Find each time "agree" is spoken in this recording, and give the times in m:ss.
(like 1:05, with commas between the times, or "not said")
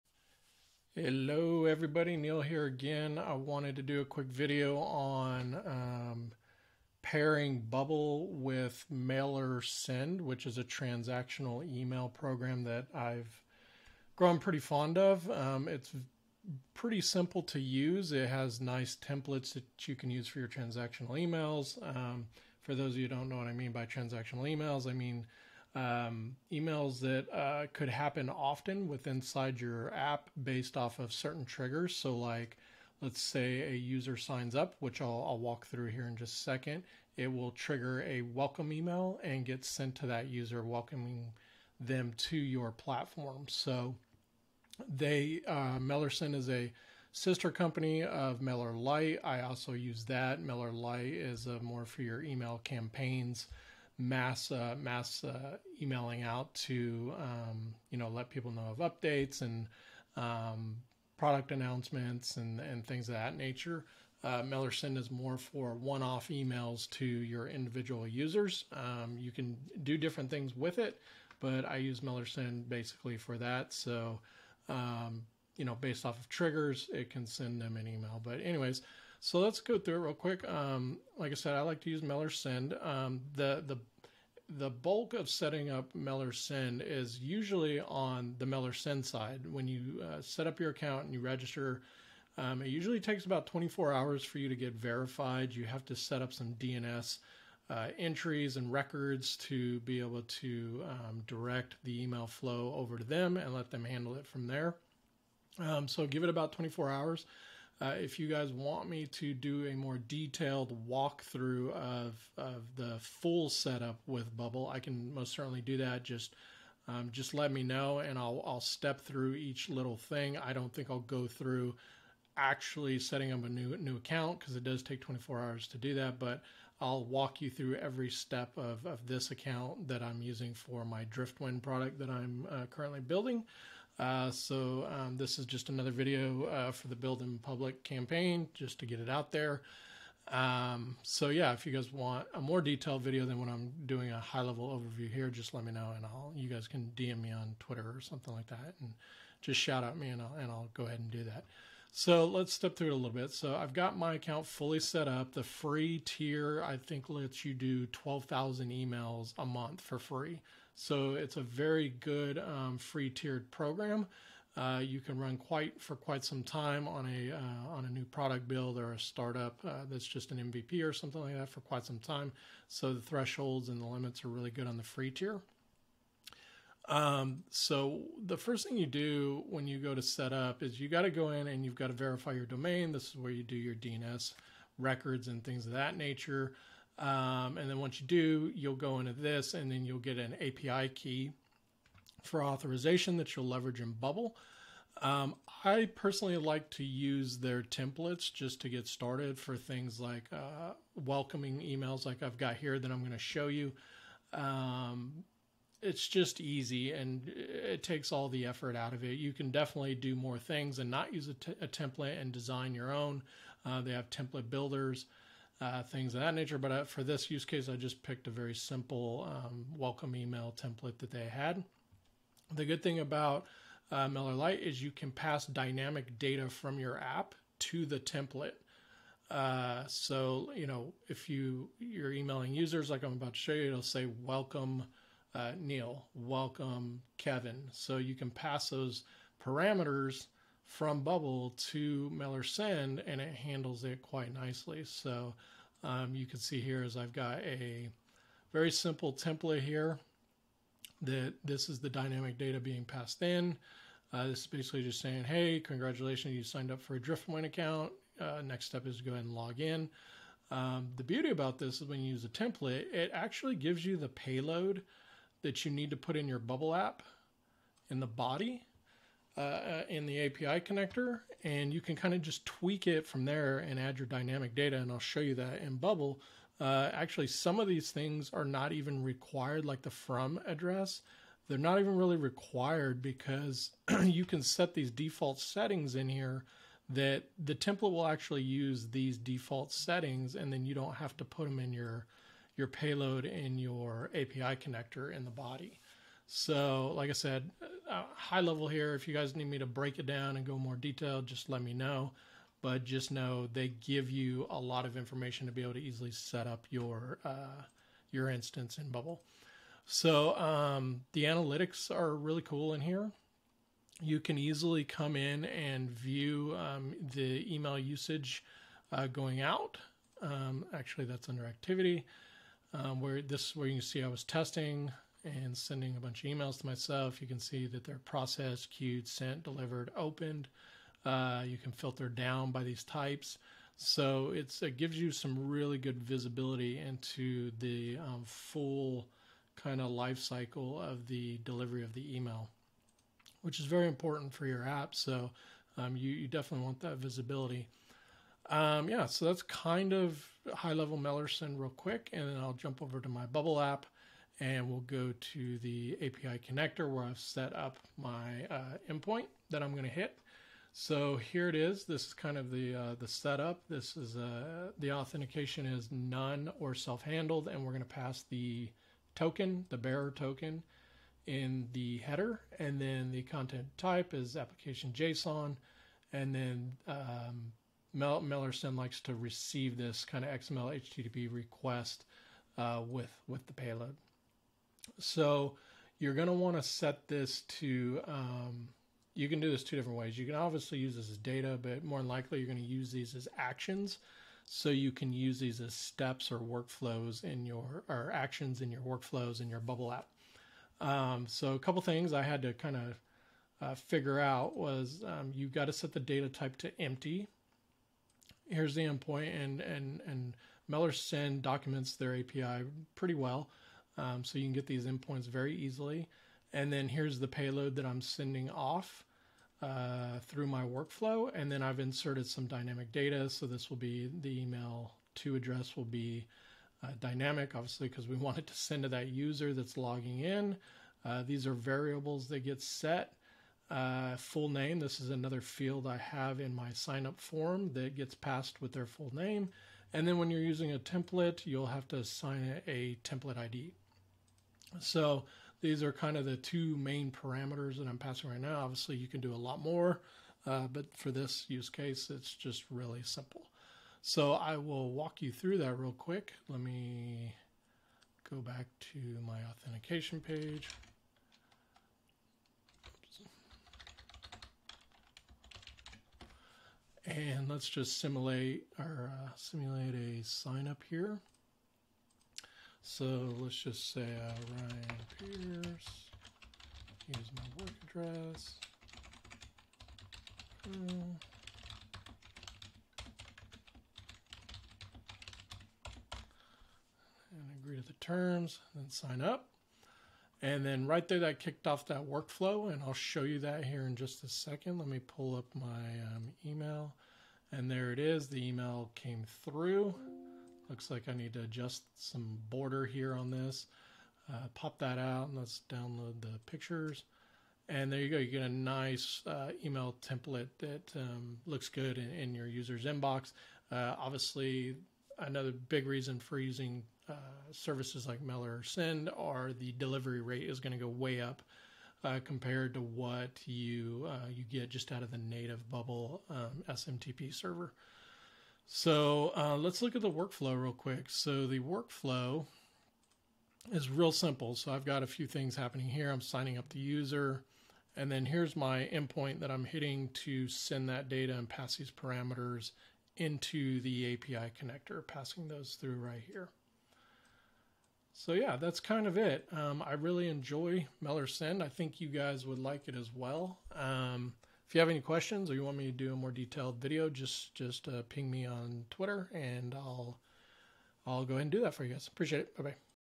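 8:07.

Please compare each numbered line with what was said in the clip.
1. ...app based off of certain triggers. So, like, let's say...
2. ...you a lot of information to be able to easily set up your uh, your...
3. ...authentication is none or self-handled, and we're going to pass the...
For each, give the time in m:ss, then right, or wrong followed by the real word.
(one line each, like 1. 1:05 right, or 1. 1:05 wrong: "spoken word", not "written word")
1. 0:29 right
2. 5:04 right
3. 6:04 right.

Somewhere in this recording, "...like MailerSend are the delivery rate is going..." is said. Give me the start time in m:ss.
8:38.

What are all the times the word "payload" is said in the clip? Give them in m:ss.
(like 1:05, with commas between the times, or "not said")
4:24, 4:52, 6:23, 6:57.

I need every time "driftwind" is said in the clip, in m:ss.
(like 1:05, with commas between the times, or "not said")
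2:11, 4:16.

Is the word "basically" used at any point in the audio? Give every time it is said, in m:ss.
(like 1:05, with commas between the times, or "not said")
1:12, 4:14.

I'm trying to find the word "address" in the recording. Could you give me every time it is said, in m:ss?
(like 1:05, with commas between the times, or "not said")
4:40, 7:05, 7:58.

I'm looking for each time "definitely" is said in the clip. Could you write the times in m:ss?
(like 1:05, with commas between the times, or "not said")
3:29, 5:46.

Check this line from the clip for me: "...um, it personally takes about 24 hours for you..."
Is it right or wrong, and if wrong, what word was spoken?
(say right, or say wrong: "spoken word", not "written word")
wrong: "usually", not "personally".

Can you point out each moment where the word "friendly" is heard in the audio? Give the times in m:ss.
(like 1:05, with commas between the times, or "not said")
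not said.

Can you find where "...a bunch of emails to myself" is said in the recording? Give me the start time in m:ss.
5:25.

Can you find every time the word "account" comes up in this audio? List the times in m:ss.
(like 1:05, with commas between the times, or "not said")
1:30, 2:03, 2:09, 2:34, 4:17.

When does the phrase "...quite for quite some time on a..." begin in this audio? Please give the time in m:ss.
2:45.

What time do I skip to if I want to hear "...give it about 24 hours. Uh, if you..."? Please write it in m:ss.
1:46.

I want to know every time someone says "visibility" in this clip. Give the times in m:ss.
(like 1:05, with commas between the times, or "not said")
5:36, 5:46.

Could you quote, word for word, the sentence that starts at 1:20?
Um, like I said, I like to use MailerSend.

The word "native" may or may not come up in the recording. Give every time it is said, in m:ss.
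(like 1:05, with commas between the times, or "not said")
8:45.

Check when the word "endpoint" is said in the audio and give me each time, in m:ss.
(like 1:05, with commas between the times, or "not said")
5:58, 6:48, 6:54, 8:58.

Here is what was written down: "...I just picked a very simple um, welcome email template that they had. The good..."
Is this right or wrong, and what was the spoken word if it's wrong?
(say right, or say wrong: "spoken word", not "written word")
right.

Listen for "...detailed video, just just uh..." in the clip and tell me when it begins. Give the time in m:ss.
9:16.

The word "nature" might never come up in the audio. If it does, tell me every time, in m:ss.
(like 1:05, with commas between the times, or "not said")
1:03, 3:05, 3:36.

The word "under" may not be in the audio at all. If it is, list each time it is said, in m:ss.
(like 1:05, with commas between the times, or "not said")
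5:21.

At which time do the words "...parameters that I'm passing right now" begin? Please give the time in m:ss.
7:27.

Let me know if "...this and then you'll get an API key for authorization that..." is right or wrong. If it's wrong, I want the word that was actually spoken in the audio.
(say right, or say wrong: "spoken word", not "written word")
right.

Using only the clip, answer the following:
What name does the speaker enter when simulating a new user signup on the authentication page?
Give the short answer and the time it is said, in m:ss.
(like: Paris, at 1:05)
Ryan Pierce, at 7:54.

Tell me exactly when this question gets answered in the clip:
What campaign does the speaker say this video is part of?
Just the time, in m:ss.
2:16.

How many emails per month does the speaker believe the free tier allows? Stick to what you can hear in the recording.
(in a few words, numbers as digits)
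12,000.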